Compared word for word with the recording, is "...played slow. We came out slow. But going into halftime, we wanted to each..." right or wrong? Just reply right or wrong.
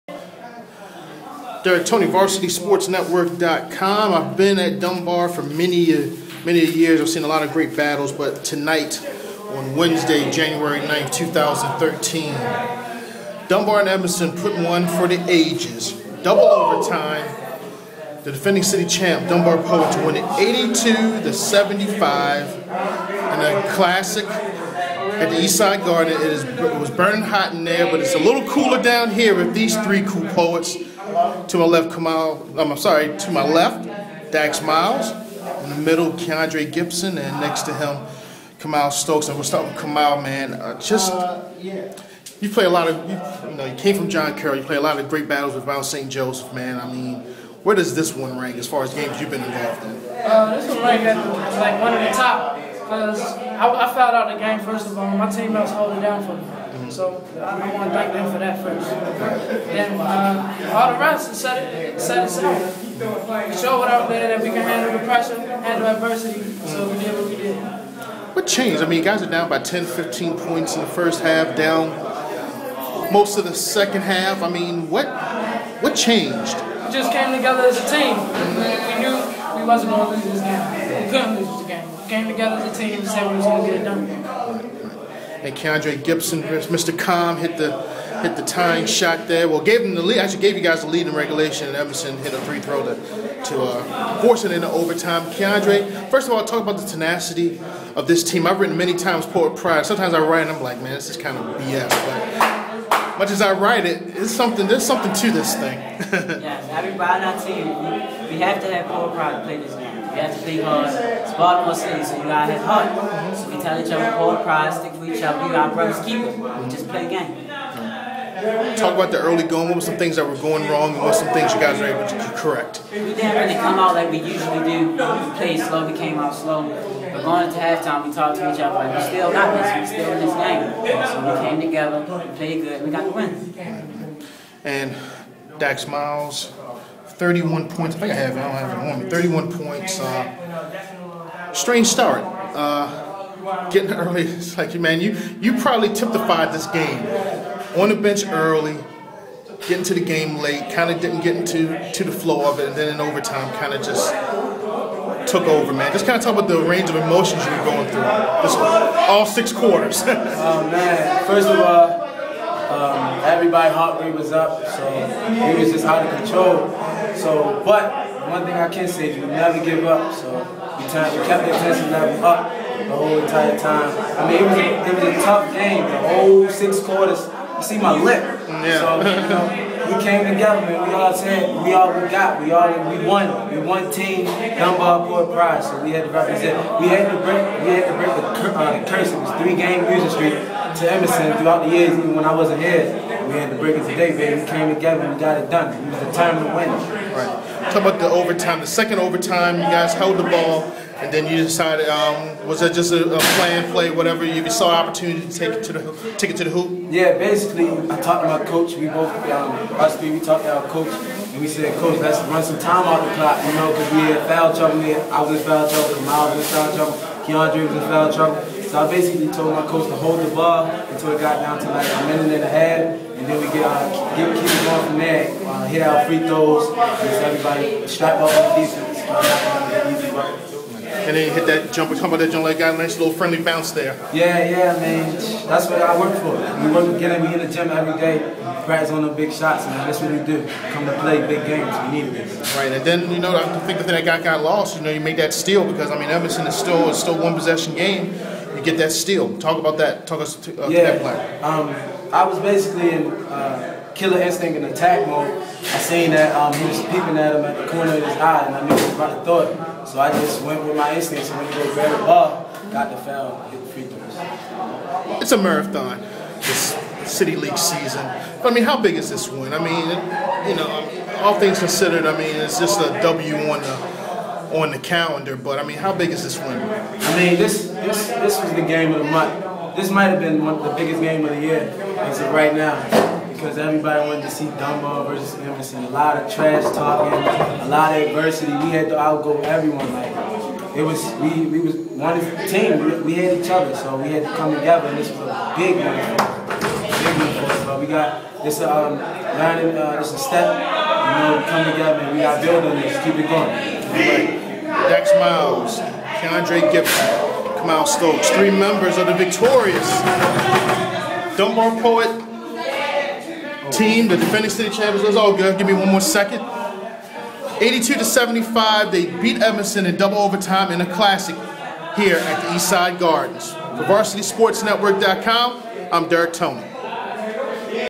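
wrong.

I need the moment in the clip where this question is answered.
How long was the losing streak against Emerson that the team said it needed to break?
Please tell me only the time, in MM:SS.
03:09.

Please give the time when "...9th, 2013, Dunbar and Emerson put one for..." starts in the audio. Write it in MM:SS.
00:10.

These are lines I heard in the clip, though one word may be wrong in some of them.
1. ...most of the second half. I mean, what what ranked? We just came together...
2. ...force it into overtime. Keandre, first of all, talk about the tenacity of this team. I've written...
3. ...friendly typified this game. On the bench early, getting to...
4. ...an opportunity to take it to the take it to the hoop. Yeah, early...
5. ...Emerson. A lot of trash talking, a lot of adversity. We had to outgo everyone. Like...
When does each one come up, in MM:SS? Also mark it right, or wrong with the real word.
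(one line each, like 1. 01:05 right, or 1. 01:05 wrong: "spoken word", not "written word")
1. 01:13 wrong: "changed", not "ranked"
2. 01:34 right
3. 02:25 wrong: "probably", not "friendly"
4. 03:24 wrong: "basically", not "early"
5. 04:45 right.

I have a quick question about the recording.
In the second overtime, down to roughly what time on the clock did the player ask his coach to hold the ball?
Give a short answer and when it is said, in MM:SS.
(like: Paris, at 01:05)
A minute and a half, at 03:41.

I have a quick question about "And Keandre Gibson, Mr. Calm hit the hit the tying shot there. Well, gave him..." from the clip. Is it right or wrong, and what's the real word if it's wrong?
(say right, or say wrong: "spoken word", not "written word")
right.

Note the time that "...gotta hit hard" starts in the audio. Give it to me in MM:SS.
01:52.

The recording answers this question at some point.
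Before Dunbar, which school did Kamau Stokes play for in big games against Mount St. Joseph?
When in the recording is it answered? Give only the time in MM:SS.
00:44.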